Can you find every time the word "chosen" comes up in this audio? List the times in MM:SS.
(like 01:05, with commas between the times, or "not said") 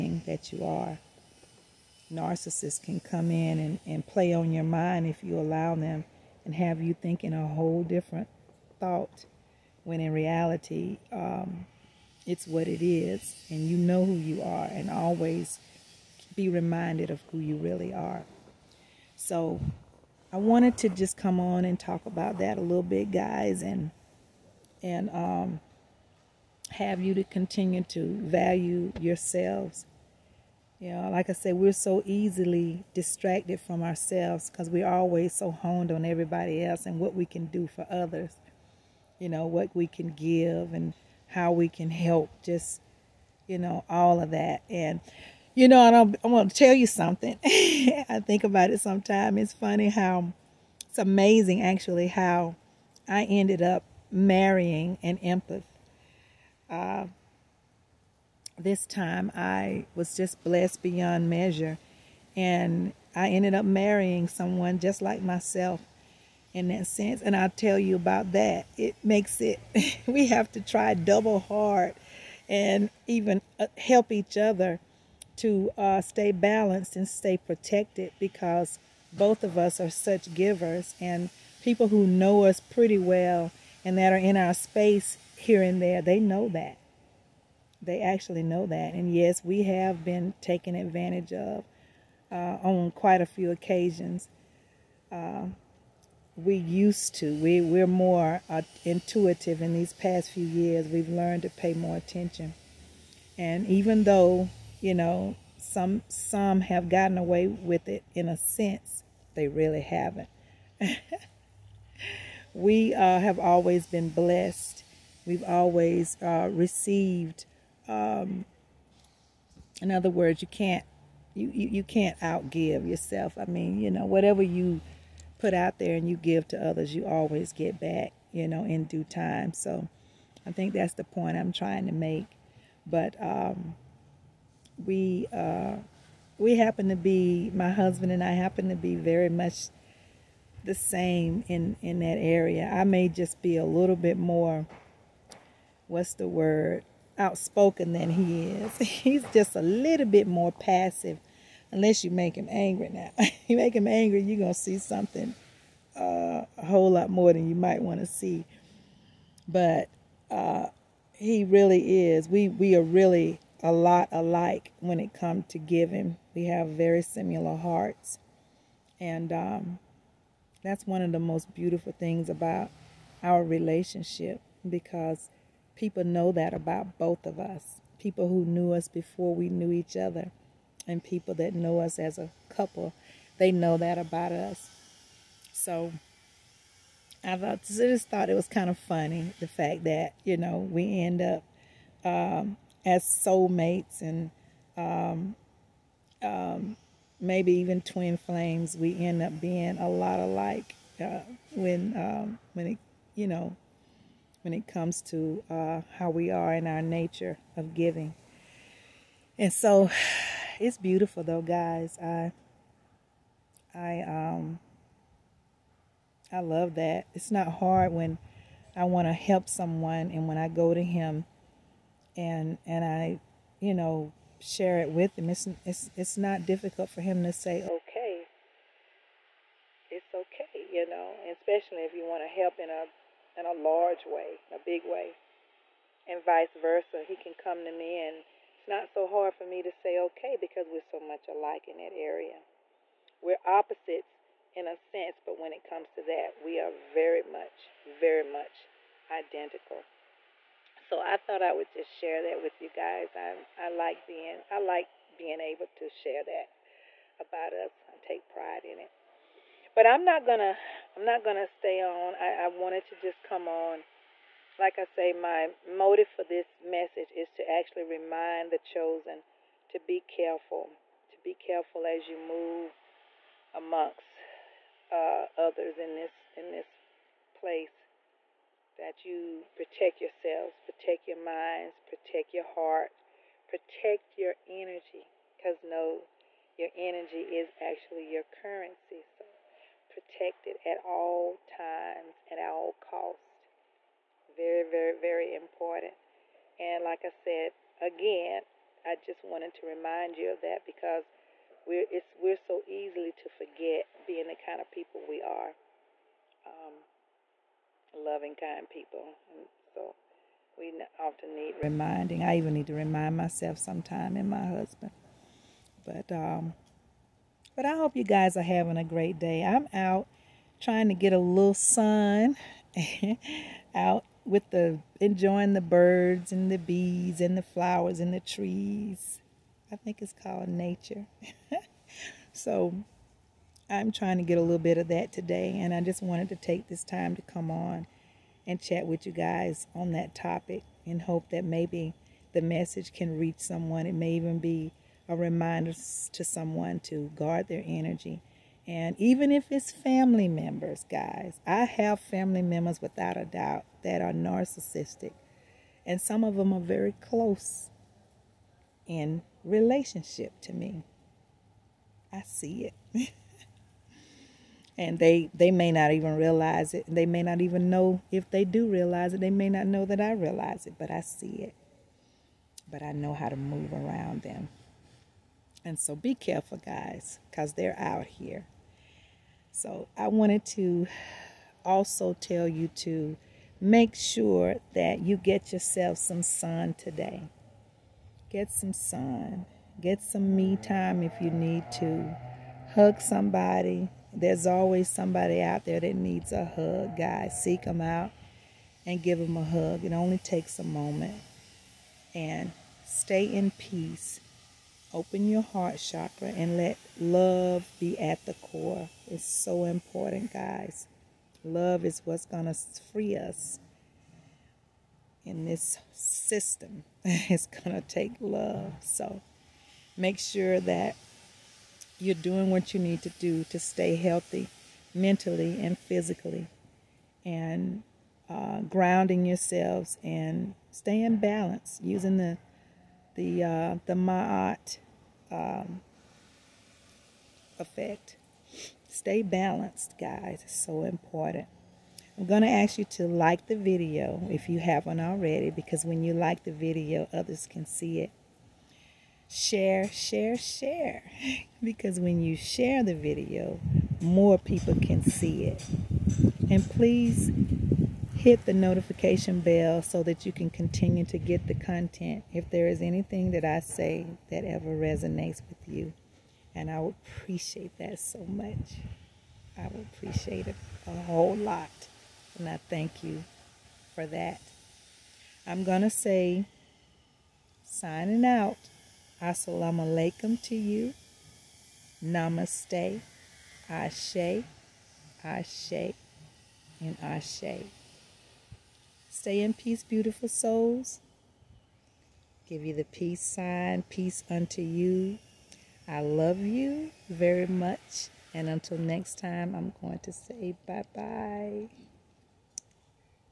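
04:28.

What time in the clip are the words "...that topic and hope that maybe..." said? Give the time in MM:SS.
05:39.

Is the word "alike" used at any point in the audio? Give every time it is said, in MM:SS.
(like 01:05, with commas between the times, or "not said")
02:44, 03:20, 04:01.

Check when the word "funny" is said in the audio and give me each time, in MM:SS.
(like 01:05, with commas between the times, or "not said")
00:49, 03:08.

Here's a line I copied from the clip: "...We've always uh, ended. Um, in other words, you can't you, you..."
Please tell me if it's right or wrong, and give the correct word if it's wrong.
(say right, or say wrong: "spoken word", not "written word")
wrong: "received", not "ended".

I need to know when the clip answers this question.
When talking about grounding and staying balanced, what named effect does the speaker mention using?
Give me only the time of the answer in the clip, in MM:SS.
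07:13.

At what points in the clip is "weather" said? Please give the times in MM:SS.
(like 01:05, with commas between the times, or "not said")
not said.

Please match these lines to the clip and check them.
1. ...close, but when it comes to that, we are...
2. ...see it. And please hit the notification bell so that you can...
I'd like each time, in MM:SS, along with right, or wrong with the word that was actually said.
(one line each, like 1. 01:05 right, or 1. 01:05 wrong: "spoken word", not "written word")
1. 04:04 wrong: "sense", not "close"
2. 07:35 right.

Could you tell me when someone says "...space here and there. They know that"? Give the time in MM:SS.
01:24.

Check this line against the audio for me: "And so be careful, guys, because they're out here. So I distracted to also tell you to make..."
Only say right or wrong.
wrong.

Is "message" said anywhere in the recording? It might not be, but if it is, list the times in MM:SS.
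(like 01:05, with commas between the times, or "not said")
04:26, 05:42.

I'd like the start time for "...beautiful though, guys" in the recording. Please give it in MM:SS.
03:30.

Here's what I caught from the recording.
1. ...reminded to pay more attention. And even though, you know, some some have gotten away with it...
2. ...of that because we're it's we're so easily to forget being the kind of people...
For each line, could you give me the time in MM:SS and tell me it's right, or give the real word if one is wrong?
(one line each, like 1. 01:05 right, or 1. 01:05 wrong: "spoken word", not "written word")
1. 01:41 wrong: "learned", not "reminded"
2. 05:00 right.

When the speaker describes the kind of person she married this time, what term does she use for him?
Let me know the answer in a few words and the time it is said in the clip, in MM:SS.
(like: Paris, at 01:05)
an empath, at 00:55.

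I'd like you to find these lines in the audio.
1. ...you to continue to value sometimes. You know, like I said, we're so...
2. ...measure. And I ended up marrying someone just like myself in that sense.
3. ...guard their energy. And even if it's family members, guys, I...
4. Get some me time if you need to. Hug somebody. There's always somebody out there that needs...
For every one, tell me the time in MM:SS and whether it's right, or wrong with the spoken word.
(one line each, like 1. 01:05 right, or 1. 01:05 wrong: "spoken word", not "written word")
1. 00:26 wrong: "yourselves", not "sometimes"
2. 01:01 right
3. 05:47 right
4. 06:29 right.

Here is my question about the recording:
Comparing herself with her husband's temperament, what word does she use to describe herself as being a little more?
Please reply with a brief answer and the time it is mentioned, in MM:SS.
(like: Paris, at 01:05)
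outspoken, at 02:27.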